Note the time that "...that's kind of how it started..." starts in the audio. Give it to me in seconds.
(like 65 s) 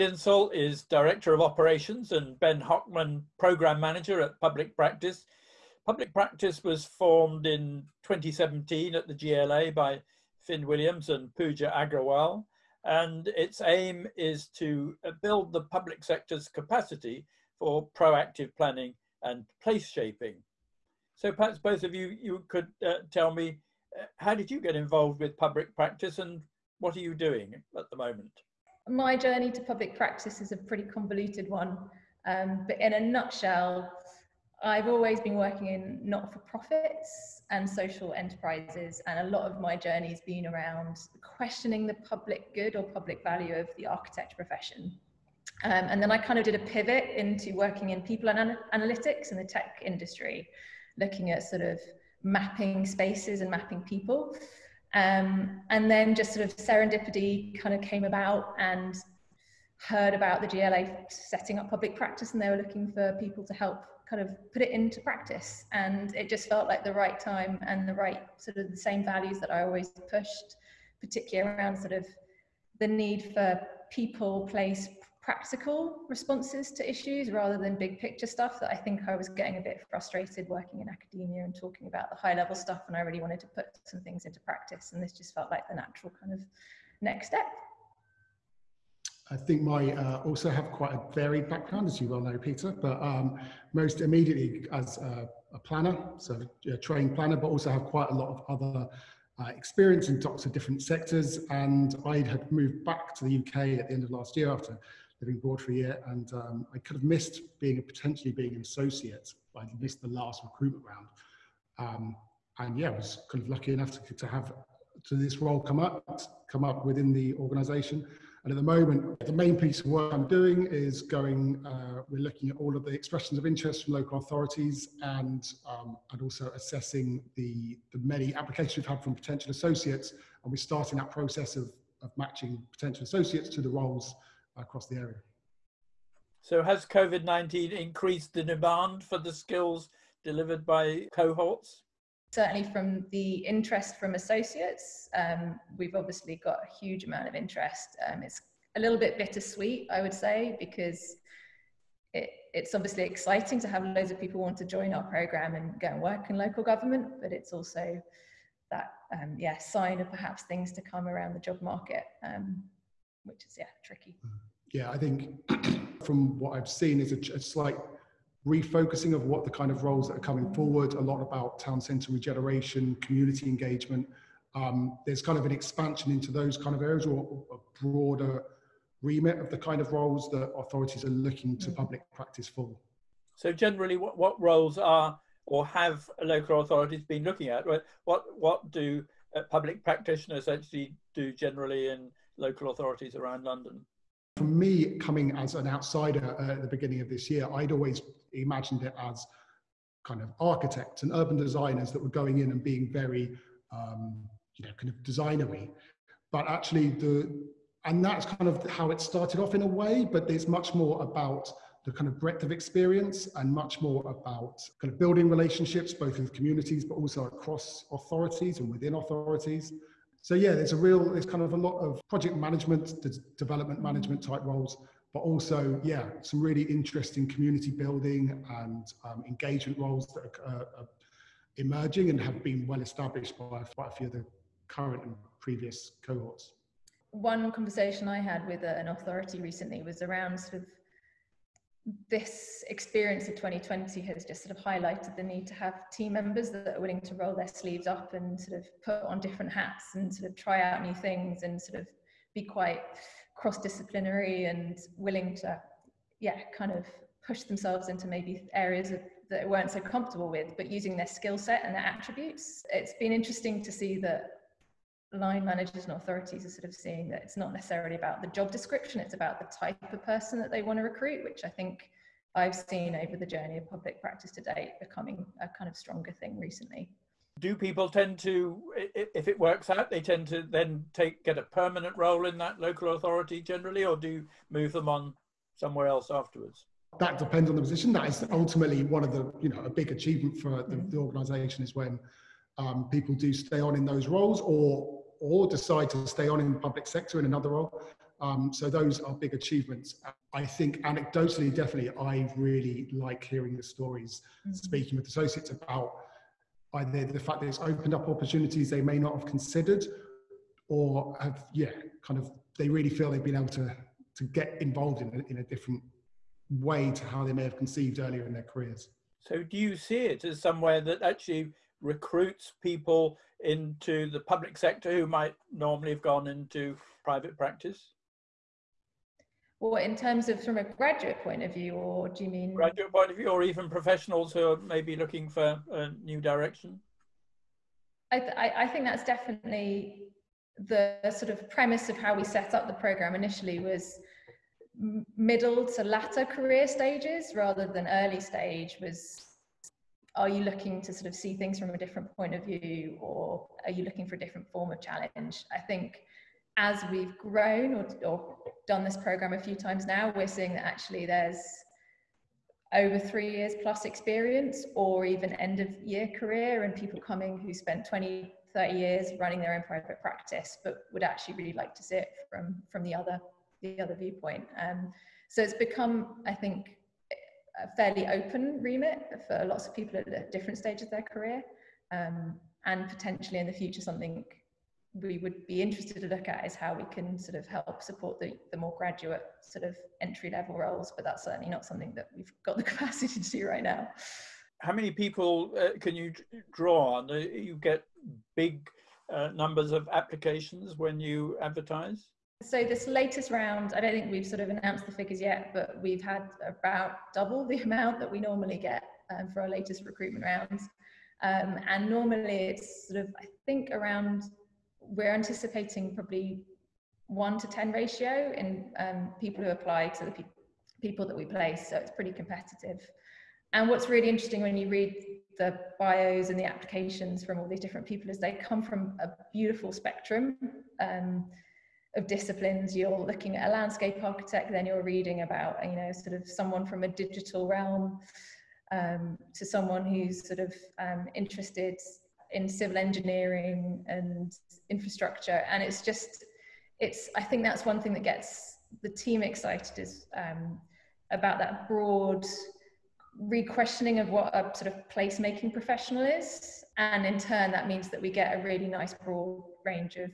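208 s.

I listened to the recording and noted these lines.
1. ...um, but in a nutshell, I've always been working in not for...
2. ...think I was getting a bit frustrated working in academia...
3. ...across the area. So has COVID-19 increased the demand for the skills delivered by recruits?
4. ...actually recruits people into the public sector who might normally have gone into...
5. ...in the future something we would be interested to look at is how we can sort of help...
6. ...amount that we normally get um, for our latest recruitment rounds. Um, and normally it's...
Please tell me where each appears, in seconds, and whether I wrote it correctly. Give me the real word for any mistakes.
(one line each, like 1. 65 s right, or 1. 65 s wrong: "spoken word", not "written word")
1. 32 s right
2. 78 s right
3. 134 s wrong: "cohorts", not "recruits"
4. 321 s right
5. 383 s right
6. 407 s right.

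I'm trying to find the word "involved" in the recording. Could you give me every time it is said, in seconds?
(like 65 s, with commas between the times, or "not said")
24 s, 314 s.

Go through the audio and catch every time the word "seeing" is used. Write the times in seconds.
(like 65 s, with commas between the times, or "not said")
266 s, 360 s.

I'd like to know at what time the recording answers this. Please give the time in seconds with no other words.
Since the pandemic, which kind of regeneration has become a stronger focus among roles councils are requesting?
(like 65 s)
171 s.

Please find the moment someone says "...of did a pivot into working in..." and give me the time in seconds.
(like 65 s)
46 s.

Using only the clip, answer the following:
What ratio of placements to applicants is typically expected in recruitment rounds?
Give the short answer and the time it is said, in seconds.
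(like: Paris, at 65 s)
1 to 10, at 417 s.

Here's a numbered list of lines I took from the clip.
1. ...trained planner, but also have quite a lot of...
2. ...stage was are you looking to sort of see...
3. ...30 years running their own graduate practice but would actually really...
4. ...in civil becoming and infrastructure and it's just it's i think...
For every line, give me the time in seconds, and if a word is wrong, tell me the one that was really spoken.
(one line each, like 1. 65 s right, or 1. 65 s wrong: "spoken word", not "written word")
1. 96 s right
2. 348 s right
3. 368 s wrong: "private", not "graduate"
4. 442 s wrong: "engineering", not "becoming".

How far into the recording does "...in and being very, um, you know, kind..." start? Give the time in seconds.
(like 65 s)
202 s.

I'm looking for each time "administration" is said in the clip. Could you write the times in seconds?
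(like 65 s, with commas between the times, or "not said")
not said.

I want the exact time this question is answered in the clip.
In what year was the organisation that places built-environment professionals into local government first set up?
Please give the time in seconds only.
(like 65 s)
8 s.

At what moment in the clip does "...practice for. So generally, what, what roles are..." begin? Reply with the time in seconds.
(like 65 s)
182 s.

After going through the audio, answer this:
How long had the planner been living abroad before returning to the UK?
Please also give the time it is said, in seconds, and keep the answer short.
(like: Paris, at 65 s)
A year, at 105 s.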